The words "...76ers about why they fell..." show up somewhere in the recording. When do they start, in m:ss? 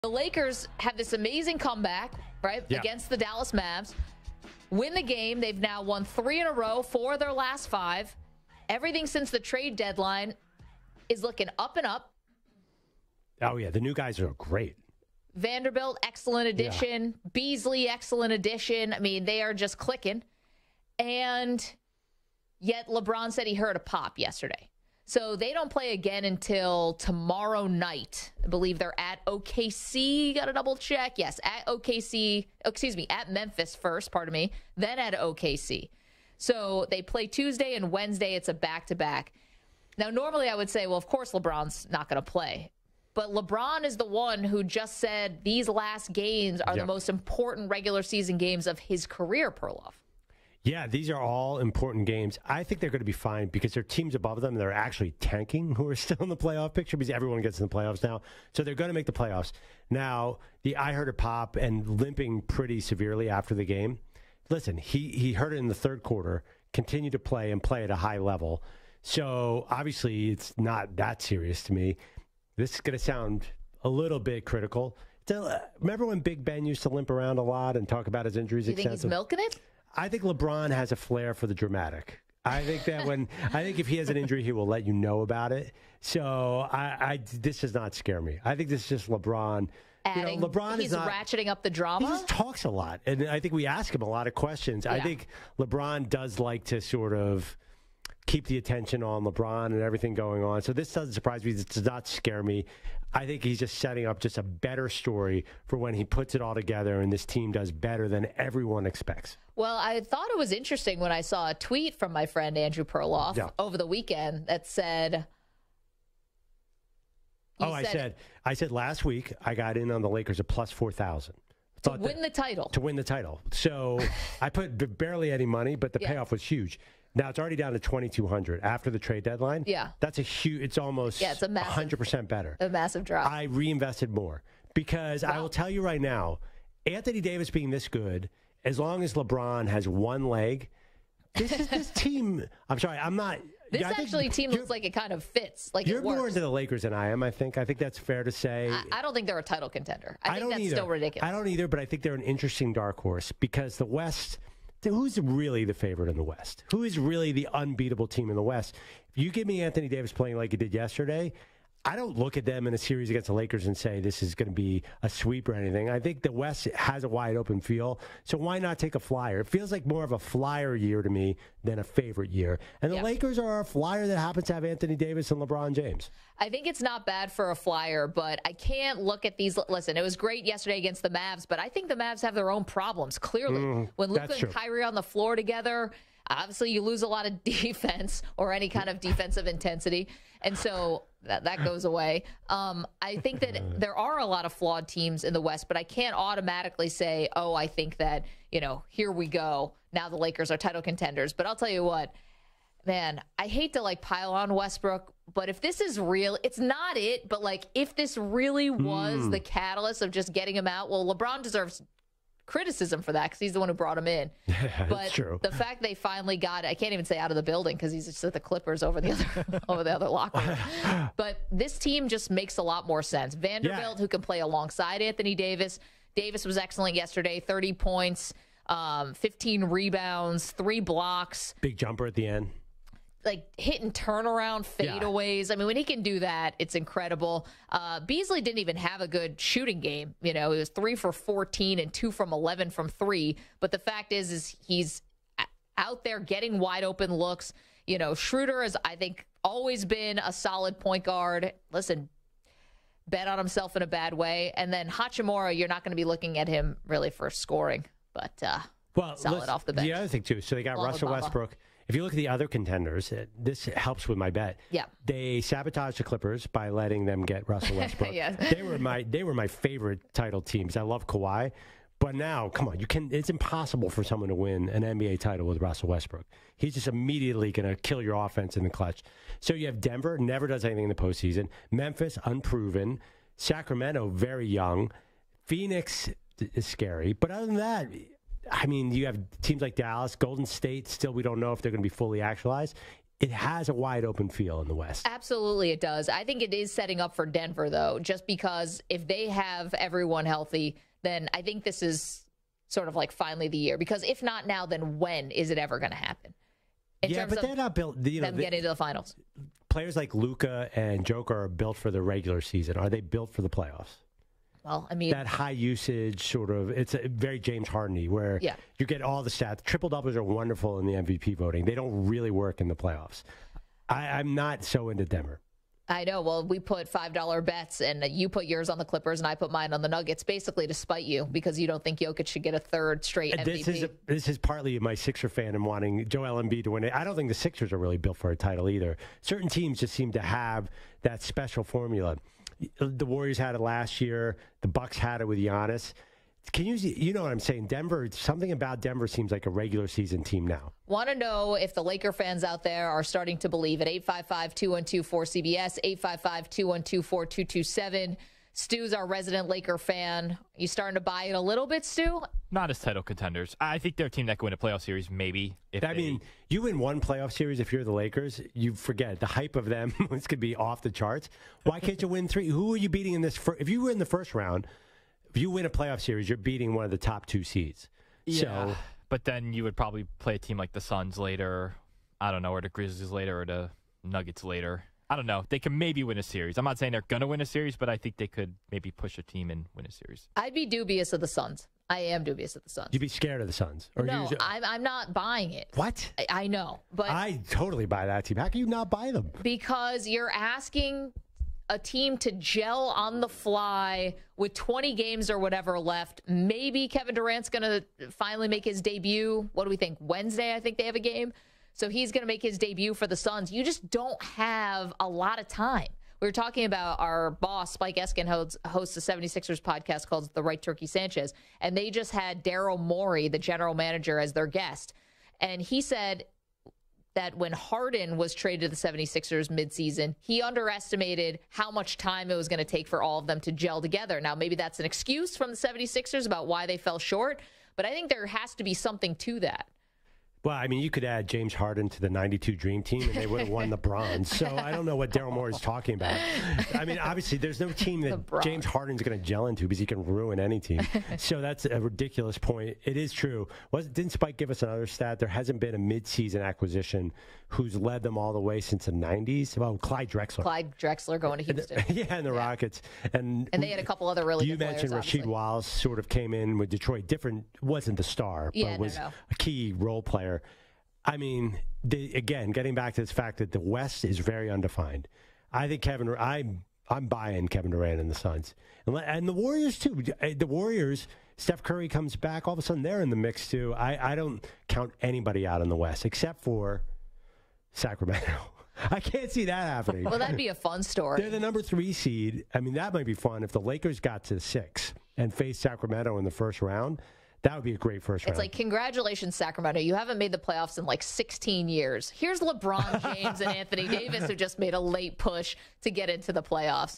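7:15.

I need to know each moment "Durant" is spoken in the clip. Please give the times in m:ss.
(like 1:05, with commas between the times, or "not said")
6:47, 7:57.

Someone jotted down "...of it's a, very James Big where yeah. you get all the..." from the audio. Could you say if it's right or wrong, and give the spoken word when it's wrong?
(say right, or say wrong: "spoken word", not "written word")
wrong: "Hardeny", not "Big".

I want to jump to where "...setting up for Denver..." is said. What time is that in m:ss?
4:56.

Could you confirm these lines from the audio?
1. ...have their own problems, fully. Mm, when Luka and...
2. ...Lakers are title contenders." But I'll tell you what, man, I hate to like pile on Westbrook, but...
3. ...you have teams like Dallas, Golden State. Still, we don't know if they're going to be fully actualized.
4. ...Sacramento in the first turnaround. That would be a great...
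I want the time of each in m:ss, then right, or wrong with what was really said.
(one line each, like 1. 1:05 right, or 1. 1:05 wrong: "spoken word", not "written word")
1. 3:02 wrong: "clearly", not "fully"
2. 3:20 right
3. 4:48 right
4. 8:15 wrong: "round", not "turnaround".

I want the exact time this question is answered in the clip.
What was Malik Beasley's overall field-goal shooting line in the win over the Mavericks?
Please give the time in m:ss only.
4:00.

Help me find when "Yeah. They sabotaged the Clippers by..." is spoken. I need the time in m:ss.
4:24.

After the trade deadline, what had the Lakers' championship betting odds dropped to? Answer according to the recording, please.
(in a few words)
2200.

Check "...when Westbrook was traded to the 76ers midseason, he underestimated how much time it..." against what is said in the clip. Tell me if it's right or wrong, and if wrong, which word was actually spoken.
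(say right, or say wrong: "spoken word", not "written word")
wrong: "Harden", not "Westbrook".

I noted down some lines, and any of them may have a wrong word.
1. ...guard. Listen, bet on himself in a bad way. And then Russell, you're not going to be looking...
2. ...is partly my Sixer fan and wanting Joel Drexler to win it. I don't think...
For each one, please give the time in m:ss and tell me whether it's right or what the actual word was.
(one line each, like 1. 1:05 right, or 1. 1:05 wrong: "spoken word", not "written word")
1. 4:11 wrong: "Hachimura", not "Russell"
2. 5:34 wrong: "Embiid", not "Drexler".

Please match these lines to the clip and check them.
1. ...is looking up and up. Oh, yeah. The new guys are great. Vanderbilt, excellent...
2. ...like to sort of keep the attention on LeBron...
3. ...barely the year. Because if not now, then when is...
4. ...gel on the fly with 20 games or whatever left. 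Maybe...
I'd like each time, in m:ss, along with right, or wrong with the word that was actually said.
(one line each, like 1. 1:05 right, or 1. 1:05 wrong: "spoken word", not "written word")
1. 0:11 right
2. 1:36 right
3. 5:03 wrong: "finally", not "barely"
4. 6:42 right.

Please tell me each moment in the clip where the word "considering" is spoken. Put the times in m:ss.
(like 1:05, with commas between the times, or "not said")
not said.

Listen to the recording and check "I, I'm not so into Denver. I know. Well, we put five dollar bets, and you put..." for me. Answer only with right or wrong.
right.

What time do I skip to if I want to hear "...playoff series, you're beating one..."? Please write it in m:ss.
6:15.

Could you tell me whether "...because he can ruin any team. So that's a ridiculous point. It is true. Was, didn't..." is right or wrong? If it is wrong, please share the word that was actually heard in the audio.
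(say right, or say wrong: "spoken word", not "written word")
right.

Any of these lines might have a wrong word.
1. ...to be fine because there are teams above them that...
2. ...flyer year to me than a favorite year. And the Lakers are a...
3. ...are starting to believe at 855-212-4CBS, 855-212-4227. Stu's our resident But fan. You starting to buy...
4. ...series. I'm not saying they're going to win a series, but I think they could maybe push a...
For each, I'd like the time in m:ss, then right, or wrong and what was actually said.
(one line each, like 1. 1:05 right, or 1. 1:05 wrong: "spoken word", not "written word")
1. 0:52 right
2. 2:50 right
3. 5:52 wrong: "Laker", not "But"
4. 6:26 right.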